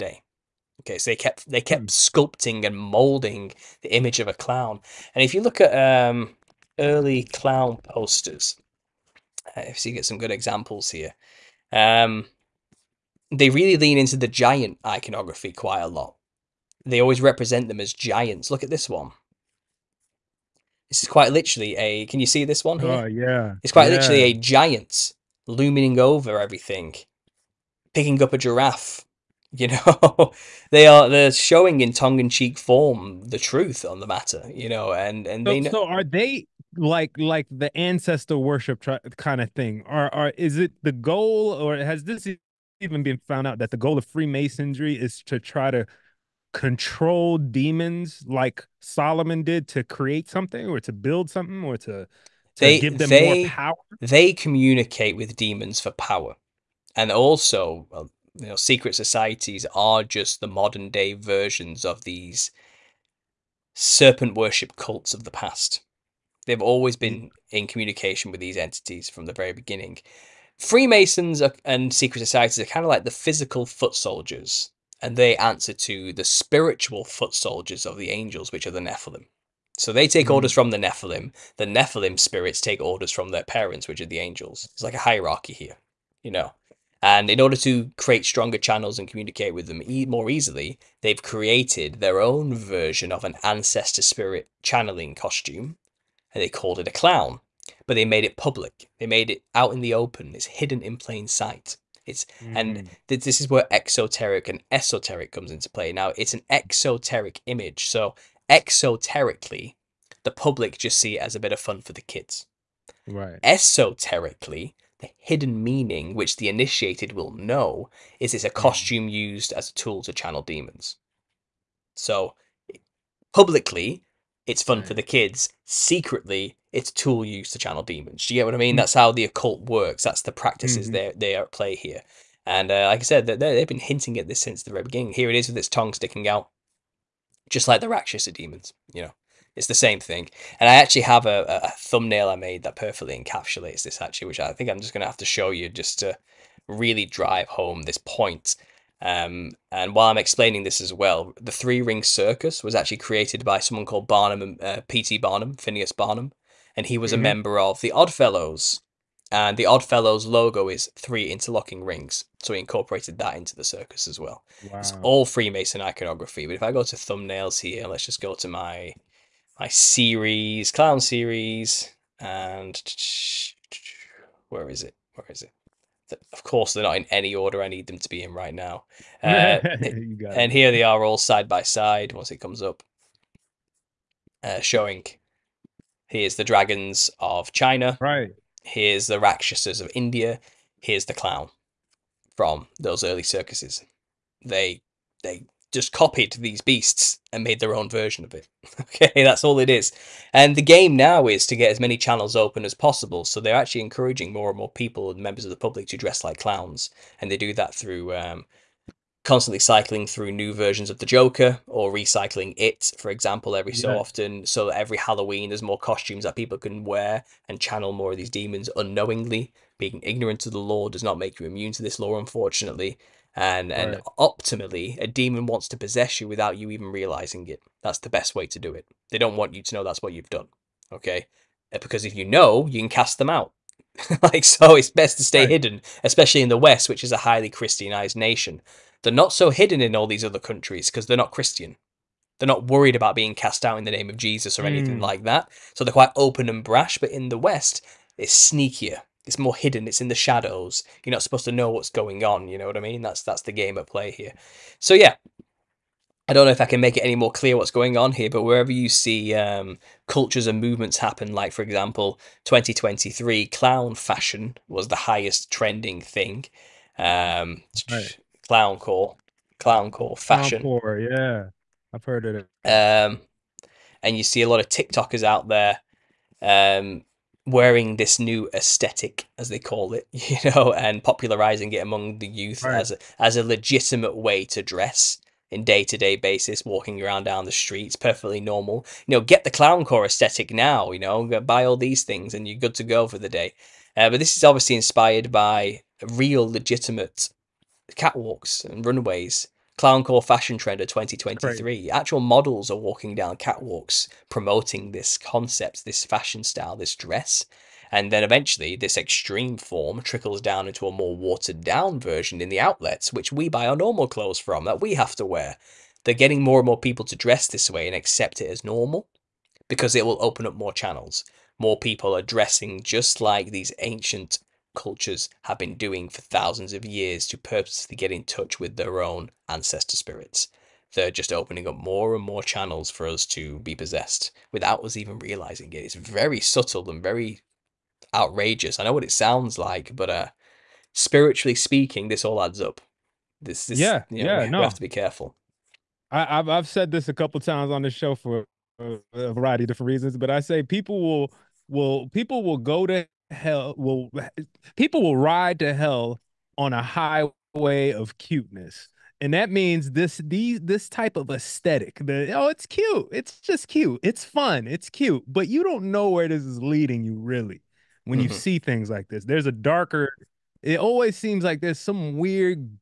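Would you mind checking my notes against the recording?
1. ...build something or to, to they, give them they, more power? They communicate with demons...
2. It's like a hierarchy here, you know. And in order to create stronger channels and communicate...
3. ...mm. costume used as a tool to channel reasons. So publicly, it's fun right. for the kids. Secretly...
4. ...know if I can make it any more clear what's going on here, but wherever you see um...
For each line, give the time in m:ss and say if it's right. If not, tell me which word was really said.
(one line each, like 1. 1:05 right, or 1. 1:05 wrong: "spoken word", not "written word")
1. 0:50 right
2. 1:24 right
3. 1:58 wrong: "demons", not "reasons"
4. 4:16 right.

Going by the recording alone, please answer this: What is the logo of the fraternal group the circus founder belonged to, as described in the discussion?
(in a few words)
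Three interlocking rings.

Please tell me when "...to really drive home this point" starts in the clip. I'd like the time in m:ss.
2:25.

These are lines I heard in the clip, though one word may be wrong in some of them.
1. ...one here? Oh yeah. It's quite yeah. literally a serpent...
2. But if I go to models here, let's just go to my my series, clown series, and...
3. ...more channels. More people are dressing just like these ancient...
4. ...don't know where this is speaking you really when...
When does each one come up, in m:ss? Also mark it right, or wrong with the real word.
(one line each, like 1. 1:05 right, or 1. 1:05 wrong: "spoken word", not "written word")
1. 0:22 wrong: "giant", not "serpent"
2. 2:46 wrong: "thumbnails", not "models"
3. 5:20 right
4. 6:05 wrong: "leading", not "speaking".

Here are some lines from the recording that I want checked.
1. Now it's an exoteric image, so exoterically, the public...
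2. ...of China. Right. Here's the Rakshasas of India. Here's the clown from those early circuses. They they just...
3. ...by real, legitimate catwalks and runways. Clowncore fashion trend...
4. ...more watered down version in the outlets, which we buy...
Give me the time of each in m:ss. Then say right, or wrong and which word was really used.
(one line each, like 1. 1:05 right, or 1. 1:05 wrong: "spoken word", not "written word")
1. 1:45 right
2. 3:07 right
3. 4:55 right
4. 5:10 right.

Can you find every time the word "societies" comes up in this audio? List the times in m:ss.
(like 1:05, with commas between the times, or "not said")
0:58, 1:12.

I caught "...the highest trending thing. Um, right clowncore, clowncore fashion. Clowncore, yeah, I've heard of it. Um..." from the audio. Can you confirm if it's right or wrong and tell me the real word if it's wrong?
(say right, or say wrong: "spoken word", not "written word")
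right.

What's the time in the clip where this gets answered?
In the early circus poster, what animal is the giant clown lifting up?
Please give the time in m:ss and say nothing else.
0:28.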